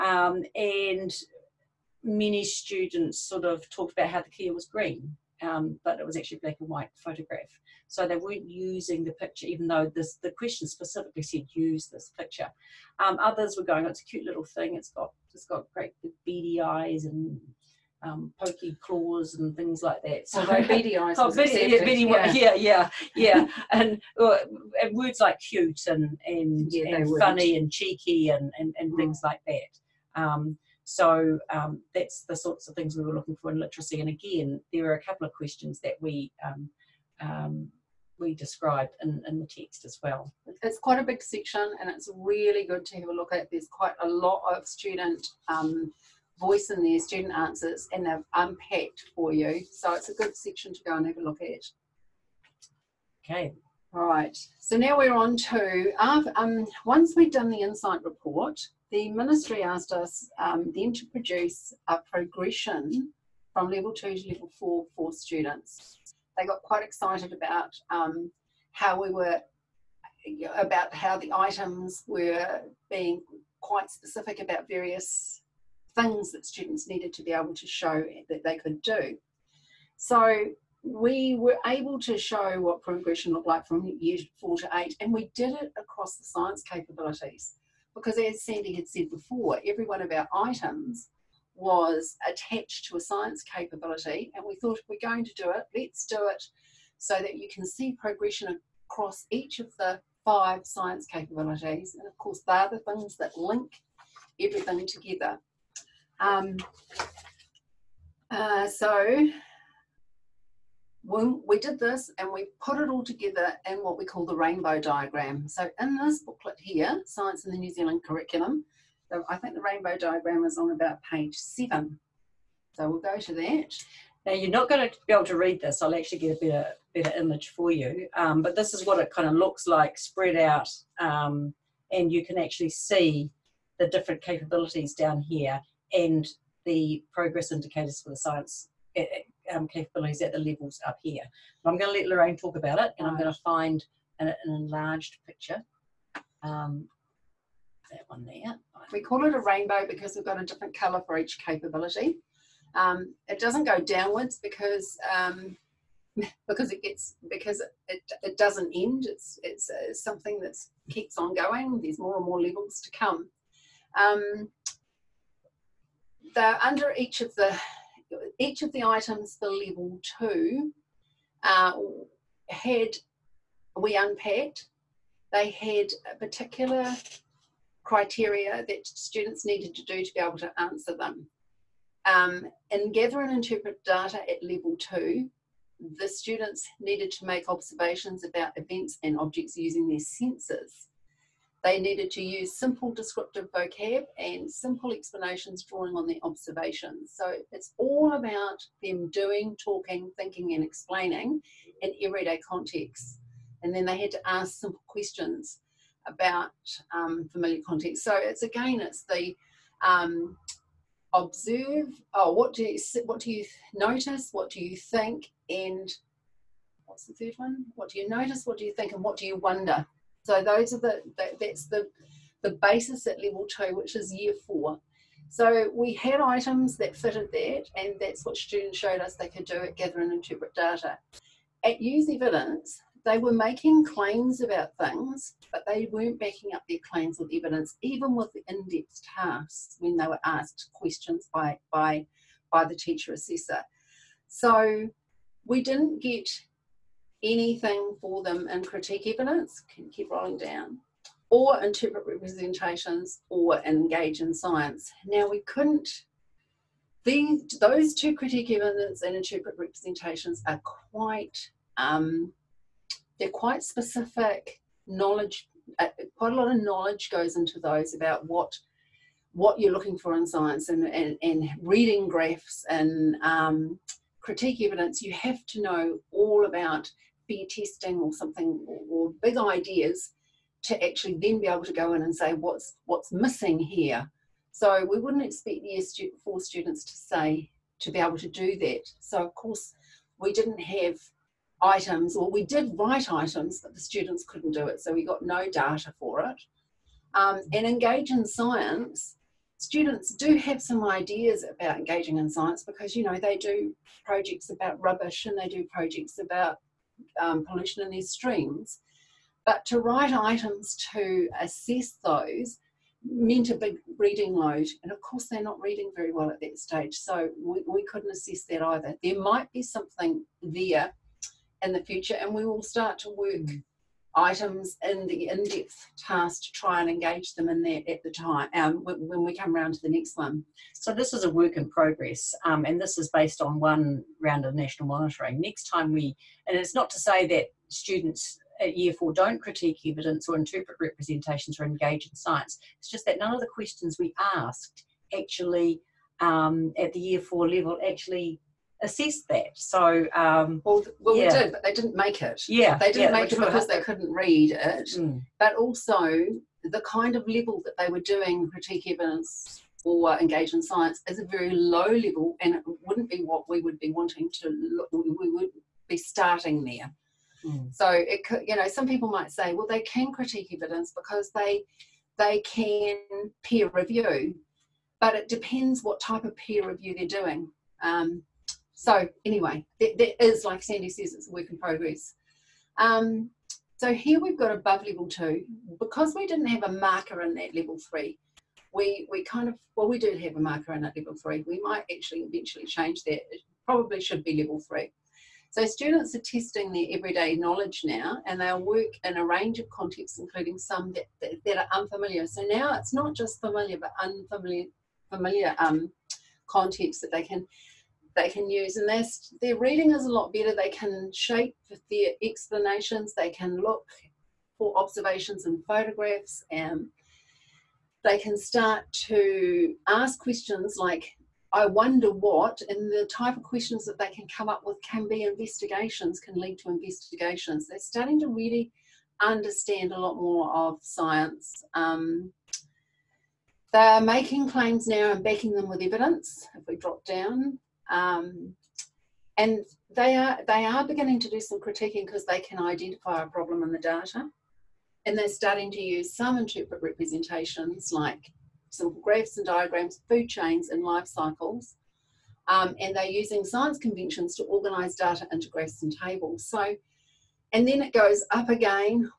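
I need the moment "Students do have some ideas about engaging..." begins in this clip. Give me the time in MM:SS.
04:59.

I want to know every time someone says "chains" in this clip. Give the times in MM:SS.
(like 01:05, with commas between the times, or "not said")
07:30.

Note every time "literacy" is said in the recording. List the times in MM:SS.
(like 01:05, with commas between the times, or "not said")
00:33.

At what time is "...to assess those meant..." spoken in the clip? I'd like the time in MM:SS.
05:10.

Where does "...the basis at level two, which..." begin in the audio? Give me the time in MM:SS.
03:42.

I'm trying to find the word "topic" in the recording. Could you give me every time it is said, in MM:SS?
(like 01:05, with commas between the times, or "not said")
not said.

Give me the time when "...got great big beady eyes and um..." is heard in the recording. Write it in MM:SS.
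00:15.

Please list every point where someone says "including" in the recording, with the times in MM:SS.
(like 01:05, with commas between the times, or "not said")
06:40.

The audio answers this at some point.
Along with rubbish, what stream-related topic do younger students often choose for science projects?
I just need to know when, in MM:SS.
05:07.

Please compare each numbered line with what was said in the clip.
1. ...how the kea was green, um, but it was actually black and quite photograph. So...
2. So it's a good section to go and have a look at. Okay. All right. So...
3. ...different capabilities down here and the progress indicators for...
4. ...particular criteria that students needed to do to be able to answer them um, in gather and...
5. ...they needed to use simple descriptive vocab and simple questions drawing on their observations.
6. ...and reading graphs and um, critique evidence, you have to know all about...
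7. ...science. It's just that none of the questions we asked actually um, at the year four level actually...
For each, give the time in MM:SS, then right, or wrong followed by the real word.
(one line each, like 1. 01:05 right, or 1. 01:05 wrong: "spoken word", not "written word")
1. 00:04 wrong: "white", not "quite"
2. 00:49 right
3. 02:13 right
4. 02:56 right
5. 03:11 wrong: "explanations", not "questions"
6. 04:31 right
7. 05:42 right.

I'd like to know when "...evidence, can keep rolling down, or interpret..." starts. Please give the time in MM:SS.
04:09.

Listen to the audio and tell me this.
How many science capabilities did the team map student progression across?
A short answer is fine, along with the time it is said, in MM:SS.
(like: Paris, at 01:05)
5, at 01:40.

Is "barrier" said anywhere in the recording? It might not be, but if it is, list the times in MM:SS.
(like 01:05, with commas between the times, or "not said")
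not said.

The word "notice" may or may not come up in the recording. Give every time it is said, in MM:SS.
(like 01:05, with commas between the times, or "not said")
03:33, 03:38.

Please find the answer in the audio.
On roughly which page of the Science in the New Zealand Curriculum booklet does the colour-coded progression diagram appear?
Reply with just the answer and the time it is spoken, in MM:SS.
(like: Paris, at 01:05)
7, at 02:01.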